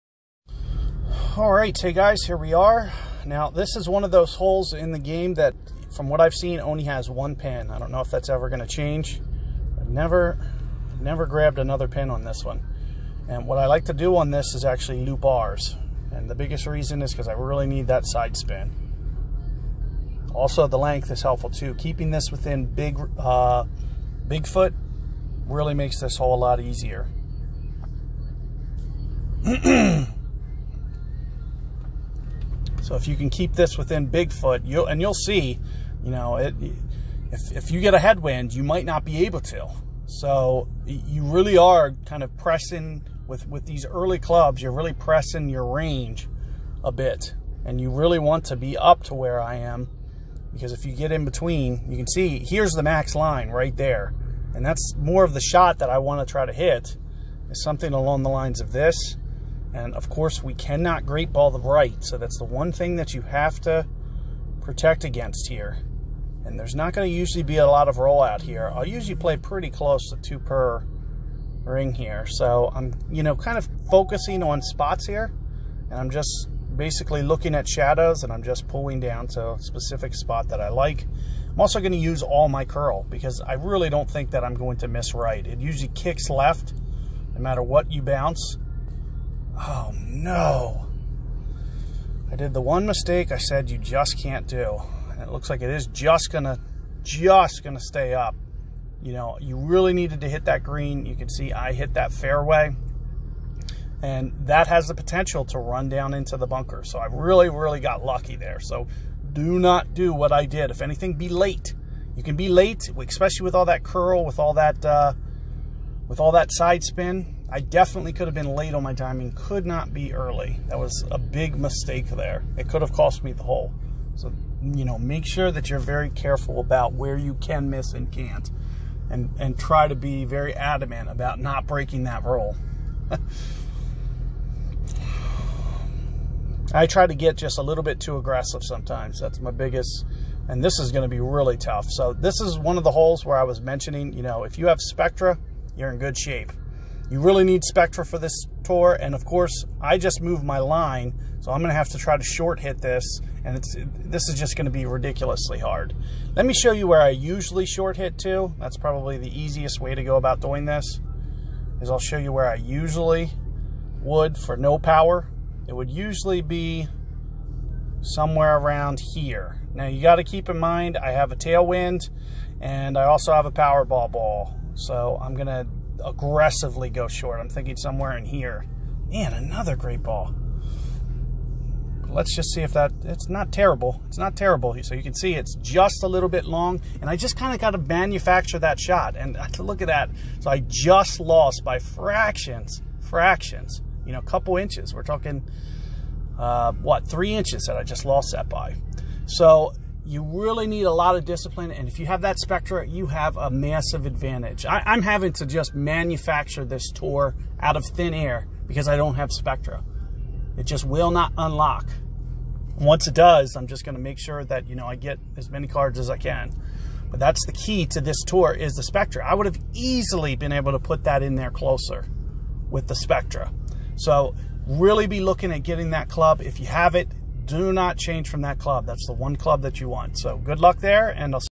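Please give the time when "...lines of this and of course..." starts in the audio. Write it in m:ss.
0:58.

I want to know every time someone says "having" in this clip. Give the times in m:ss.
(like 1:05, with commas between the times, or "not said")
3:25.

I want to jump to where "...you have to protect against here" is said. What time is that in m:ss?
1:03.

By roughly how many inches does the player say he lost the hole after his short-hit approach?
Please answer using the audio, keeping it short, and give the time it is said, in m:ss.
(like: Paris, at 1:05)
3, at 3:17.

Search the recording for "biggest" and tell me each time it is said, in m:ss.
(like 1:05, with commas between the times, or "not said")
0:16, 2:19.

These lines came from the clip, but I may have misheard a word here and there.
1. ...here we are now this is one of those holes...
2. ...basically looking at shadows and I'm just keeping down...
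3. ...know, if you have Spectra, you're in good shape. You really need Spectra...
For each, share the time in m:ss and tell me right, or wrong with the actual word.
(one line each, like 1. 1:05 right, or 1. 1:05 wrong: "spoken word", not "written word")
1. 0:02 right
2. 1:16 wrong: "pulling", not "keeping"
3. 2:24 right.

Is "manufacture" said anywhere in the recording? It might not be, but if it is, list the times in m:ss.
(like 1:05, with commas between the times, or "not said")
3:07, 3:25.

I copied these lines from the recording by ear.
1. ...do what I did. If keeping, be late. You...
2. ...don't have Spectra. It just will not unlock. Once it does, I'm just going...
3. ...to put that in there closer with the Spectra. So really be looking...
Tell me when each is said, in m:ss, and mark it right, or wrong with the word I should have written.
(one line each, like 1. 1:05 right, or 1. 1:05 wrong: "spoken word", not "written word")
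1. 1:49 wrong: "anything", not "keeping"
2. 3:28 right
3. 3:40 right.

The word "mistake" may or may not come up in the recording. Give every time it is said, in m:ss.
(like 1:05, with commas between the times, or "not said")
1:32, 2:01.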